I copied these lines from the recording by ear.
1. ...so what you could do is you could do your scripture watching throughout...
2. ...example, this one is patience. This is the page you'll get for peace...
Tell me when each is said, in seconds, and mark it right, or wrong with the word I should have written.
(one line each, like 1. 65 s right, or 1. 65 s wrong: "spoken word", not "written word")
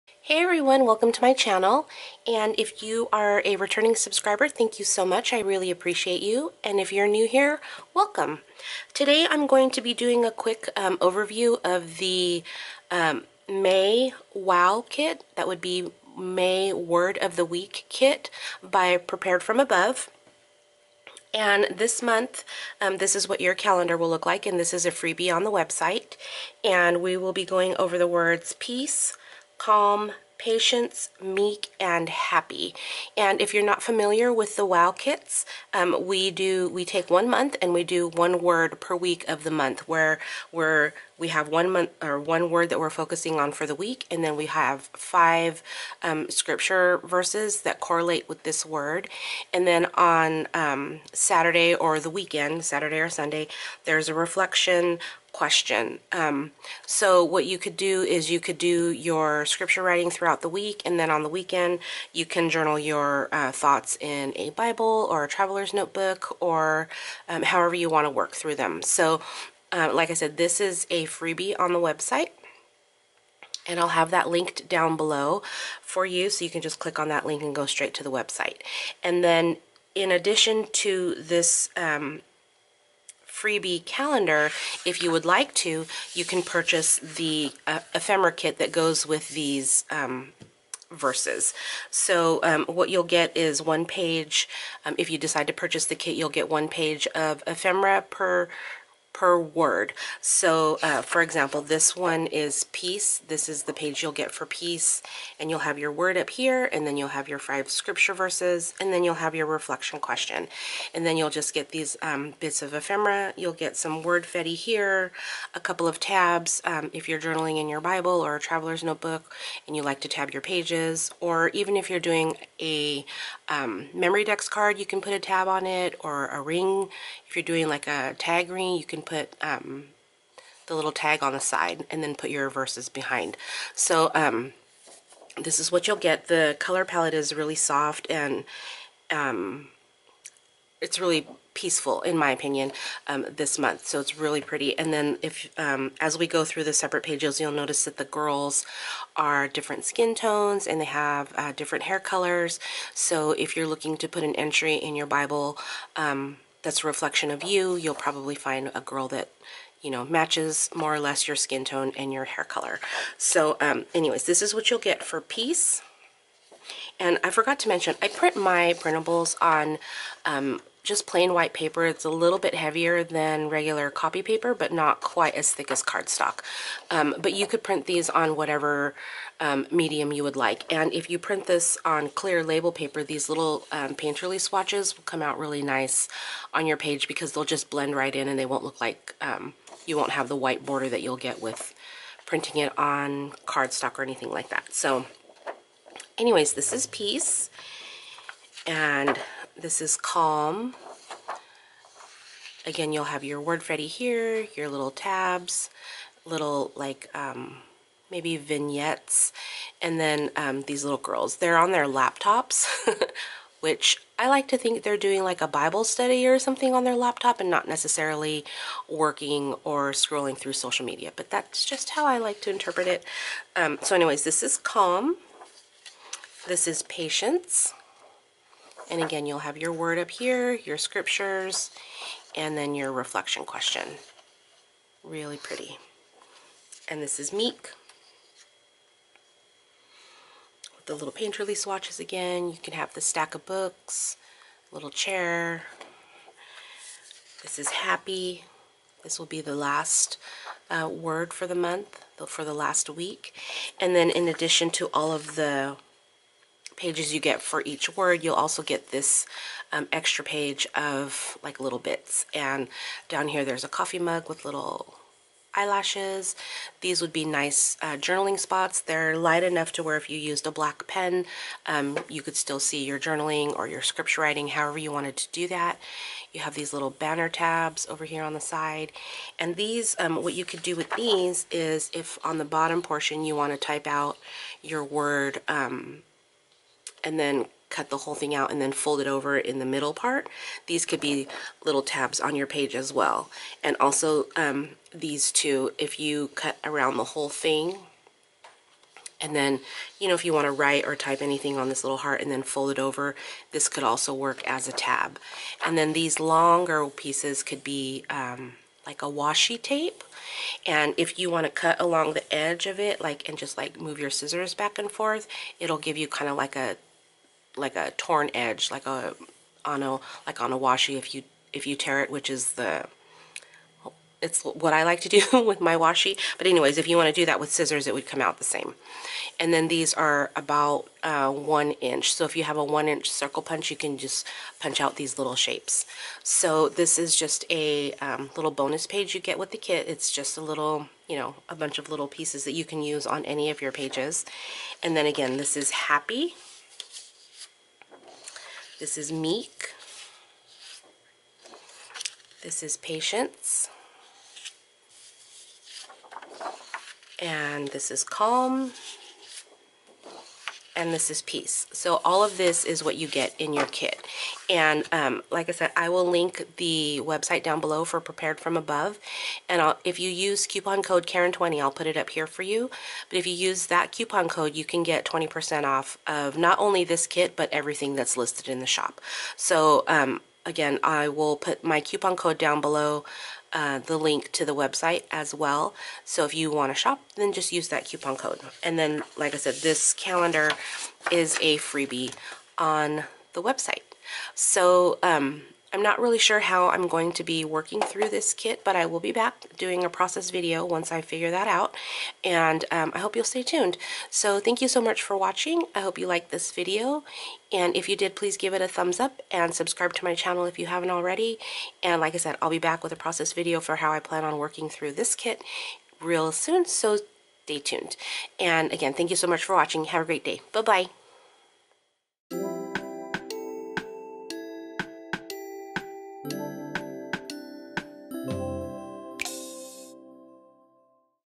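1. 56 s wrong: "writing", not "watching"
2. 101 s wrong: "peace", not "patience".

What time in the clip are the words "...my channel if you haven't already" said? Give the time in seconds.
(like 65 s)
410 s.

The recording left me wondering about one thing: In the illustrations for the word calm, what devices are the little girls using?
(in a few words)
Laptops.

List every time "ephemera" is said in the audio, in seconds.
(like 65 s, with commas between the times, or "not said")
87 s, 97 s, 112 s.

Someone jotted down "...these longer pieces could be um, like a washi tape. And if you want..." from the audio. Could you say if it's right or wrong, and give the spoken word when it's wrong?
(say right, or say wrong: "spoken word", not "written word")
right.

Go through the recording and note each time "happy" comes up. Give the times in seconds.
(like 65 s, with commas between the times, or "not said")
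32 s, 247 s, 345 s.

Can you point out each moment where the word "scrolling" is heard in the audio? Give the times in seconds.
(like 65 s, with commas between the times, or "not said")
219 s.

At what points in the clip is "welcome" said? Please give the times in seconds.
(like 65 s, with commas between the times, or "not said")
0 s, 7 s.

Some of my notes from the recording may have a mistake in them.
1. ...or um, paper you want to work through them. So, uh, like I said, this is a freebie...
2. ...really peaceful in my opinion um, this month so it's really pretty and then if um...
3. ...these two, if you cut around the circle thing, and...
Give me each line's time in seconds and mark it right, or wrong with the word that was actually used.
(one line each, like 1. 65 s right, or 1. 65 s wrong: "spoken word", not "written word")
1. 66 s wrong: "however", not "paper"
2. 140 s right
3. 294 s wrong: "whole", not "circle".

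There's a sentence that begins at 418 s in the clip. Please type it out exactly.
And again, thank you so much for watching.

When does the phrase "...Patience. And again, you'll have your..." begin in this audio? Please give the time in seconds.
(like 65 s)
226 s.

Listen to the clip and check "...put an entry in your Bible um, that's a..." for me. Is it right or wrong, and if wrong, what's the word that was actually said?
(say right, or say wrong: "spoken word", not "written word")
right.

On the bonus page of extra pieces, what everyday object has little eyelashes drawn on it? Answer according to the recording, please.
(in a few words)
Coffee mug.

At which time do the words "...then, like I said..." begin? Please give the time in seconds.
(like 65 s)
388 s.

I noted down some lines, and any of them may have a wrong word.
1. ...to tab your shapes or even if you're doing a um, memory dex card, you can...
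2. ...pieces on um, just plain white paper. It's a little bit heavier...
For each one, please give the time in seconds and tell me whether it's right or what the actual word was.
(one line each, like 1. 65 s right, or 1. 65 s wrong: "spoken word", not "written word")
1. 120 s wrong: "pages", not "shapes"
2. 168 s wrong: "printables", not "pieces".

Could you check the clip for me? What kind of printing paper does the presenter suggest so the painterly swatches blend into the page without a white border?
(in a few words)
Clear label paper.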